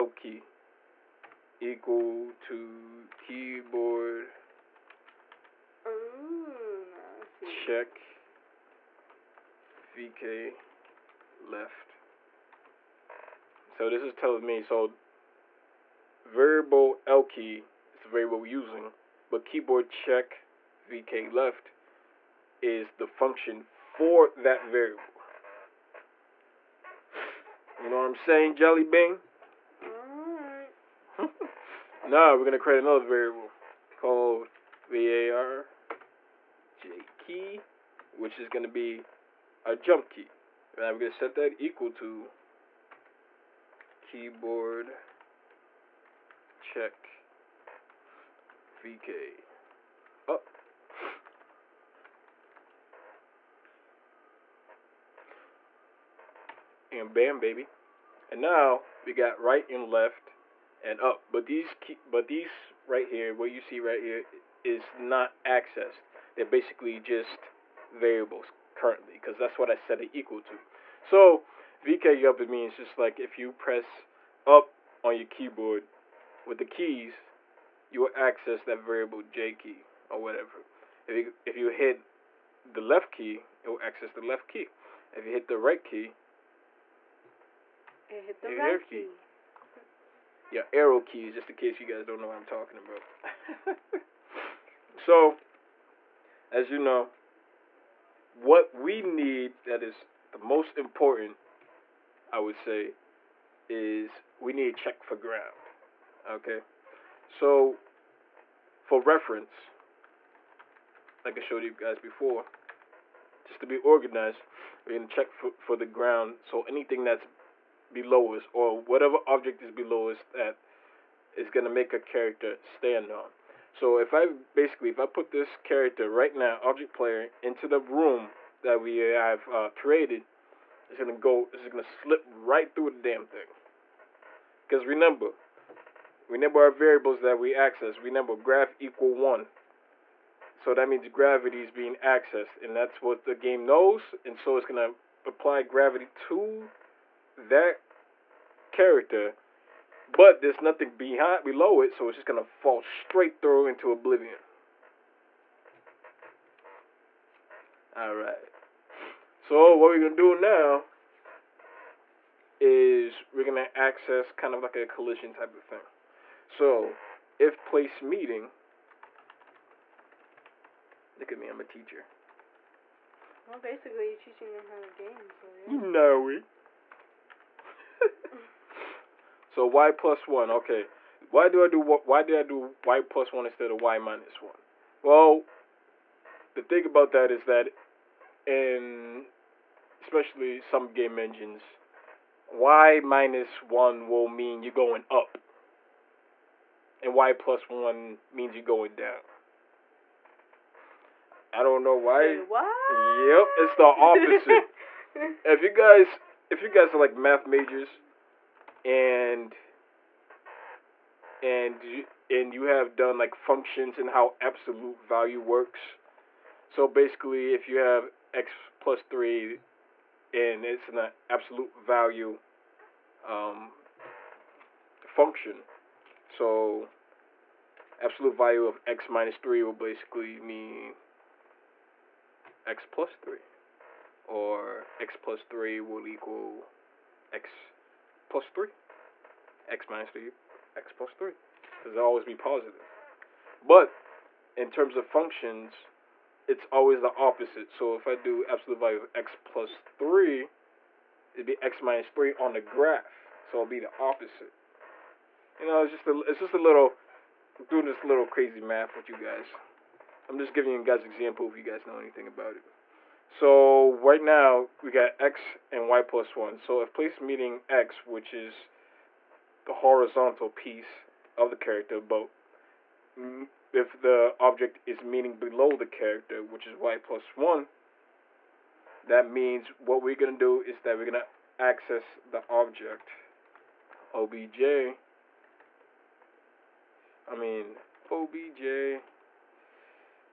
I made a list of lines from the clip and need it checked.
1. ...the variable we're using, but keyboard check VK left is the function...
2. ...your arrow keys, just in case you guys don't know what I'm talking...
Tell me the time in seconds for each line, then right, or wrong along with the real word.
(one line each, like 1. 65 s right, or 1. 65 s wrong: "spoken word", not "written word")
1. 18 s right
2. 90 s right.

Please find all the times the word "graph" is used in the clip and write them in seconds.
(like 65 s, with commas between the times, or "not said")
138 s, 252 s.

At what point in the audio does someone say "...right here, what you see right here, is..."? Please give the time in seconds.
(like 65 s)
62 s.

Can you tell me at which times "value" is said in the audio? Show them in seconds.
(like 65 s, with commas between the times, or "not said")
215 s, 221 s, 228 s, 248 s.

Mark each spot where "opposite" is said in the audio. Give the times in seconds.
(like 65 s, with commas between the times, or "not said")
203 s, 247 s, 253 s.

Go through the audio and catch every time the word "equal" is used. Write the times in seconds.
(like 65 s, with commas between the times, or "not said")
1 s, 41 s, 70 s, 138 s, 236 s.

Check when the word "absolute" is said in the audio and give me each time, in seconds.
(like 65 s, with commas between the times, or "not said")
214 s, 221 s, 228 s, 248 s.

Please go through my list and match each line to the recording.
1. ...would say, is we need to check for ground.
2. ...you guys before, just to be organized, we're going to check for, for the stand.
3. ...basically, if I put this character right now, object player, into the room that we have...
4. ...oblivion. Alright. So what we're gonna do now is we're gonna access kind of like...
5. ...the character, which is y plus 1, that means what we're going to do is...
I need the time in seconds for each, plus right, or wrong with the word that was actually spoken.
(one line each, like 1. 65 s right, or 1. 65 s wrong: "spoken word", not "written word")
1. 102 s right
2. 111 s wrong: "ground", not "stand"
3. 124 s right
4. 153 s right
5. 275 s right.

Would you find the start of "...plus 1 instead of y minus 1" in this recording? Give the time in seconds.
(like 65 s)
183 s.